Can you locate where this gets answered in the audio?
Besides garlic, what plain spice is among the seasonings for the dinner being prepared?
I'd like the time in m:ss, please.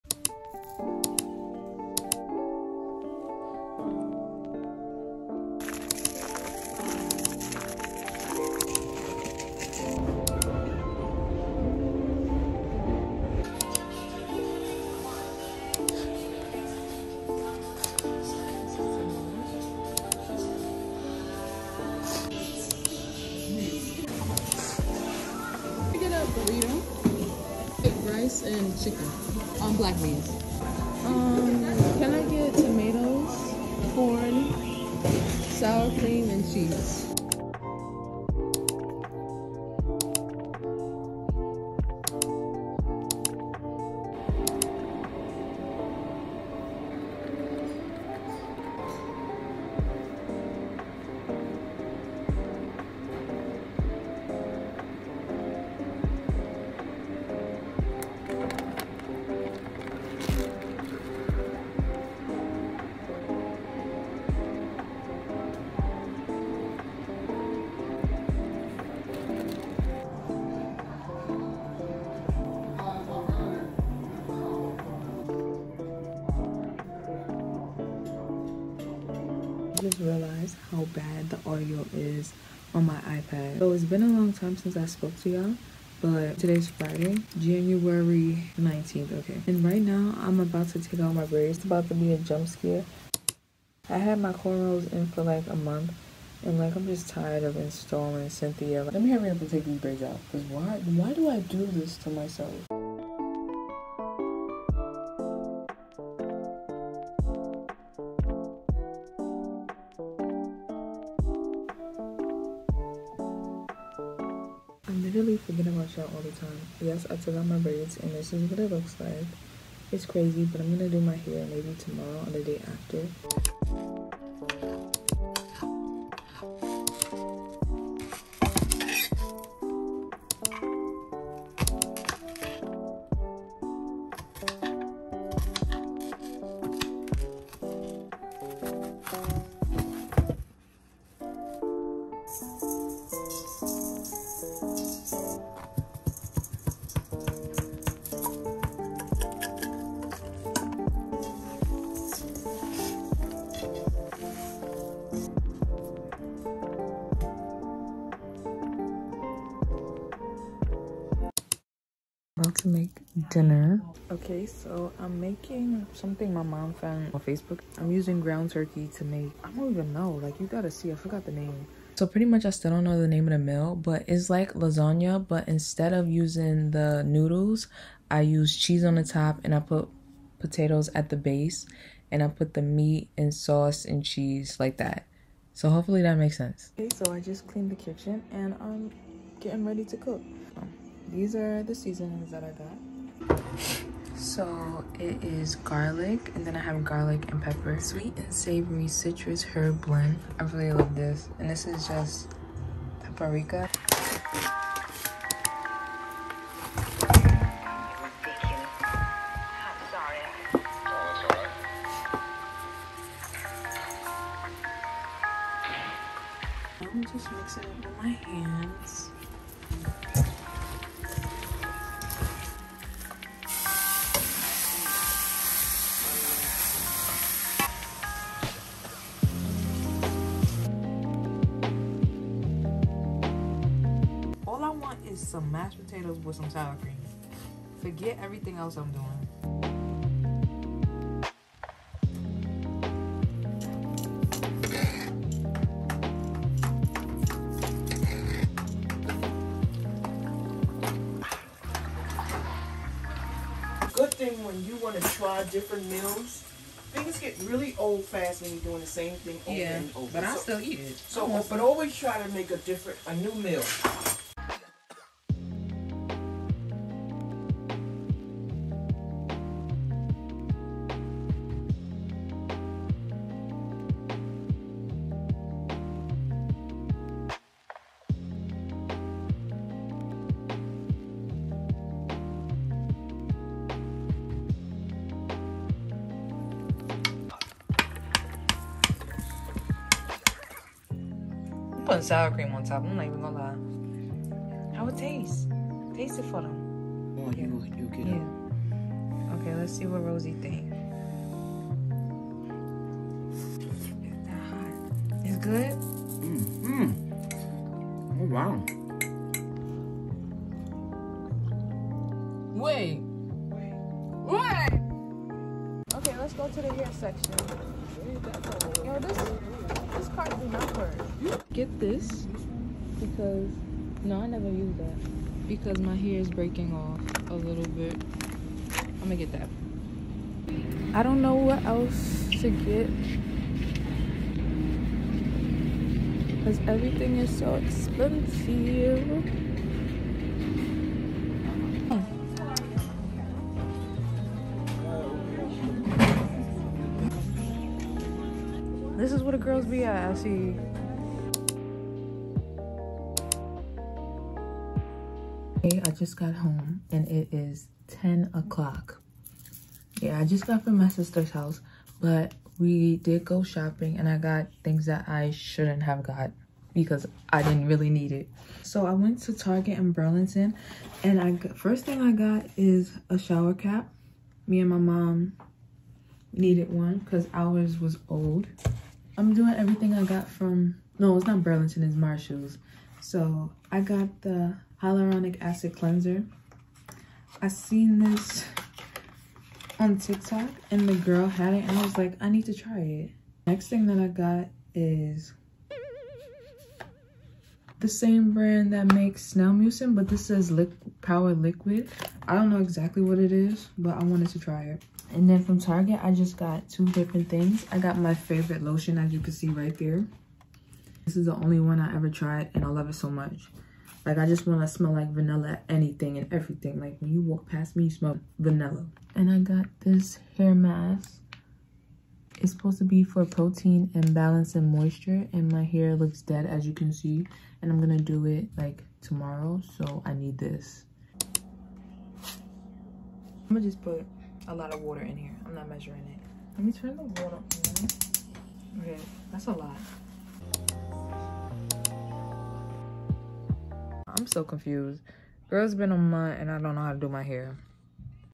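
3:23.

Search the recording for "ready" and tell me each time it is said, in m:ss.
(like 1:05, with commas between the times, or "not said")
3:09.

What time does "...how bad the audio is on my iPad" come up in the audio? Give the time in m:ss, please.
1:20.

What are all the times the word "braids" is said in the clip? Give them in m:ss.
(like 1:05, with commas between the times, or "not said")
1:31, 1:39, 1:57.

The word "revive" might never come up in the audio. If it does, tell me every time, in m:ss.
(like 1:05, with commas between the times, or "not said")
not said.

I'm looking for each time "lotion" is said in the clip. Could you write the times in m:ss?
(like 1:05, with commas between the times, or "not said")
6:48.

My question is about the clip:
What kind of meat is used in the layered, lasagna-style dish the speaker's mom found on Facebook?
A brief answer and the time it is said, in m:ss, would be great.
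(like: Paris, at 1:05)
ground turkey, at 2:48.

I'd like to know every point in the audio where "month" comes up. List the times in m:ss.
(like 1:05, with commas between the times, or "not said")
1:35, 7:25.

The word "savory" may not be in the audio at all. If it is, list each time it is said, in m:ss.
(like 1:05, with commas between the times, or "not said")
3:18.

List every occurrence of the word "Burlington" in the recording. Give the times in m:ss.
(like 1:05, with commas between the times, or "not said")
6:10, 6:21.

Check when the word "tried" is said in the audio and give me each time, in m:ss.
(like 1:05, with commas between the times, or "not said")
6:52.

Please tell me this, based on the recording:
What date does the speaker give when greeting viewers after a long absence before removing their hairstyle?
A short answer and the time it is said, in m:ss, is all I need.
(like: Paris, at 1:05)
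Friday, January 19th, at 1:26.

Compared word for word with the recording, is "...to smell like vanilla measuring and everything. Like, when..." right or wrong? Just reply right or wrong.
wrong.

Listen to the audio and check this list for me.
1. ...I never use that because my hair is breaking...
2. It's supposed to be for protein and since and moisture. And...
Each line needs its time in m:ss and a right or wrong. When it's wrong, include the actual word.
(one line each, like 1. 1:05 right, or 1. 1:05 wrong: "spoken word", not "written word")
1. 5:24 right
2. 7:02 wrong: "balance", not "since".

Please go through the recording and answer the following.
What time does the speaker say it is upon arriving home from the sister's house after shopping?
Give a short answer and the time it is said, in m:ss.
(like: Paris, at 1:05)
10 o'clock, at 5:58.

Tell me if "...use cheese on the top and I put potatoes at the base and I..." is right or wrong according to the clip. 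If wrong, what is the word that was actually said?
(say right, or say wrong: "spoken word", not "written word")
right.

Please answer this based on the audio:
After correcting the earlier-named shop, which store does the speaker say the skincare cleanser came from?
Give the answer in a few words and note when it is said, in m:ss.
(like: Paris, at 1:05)
Marshalls, at 6:21.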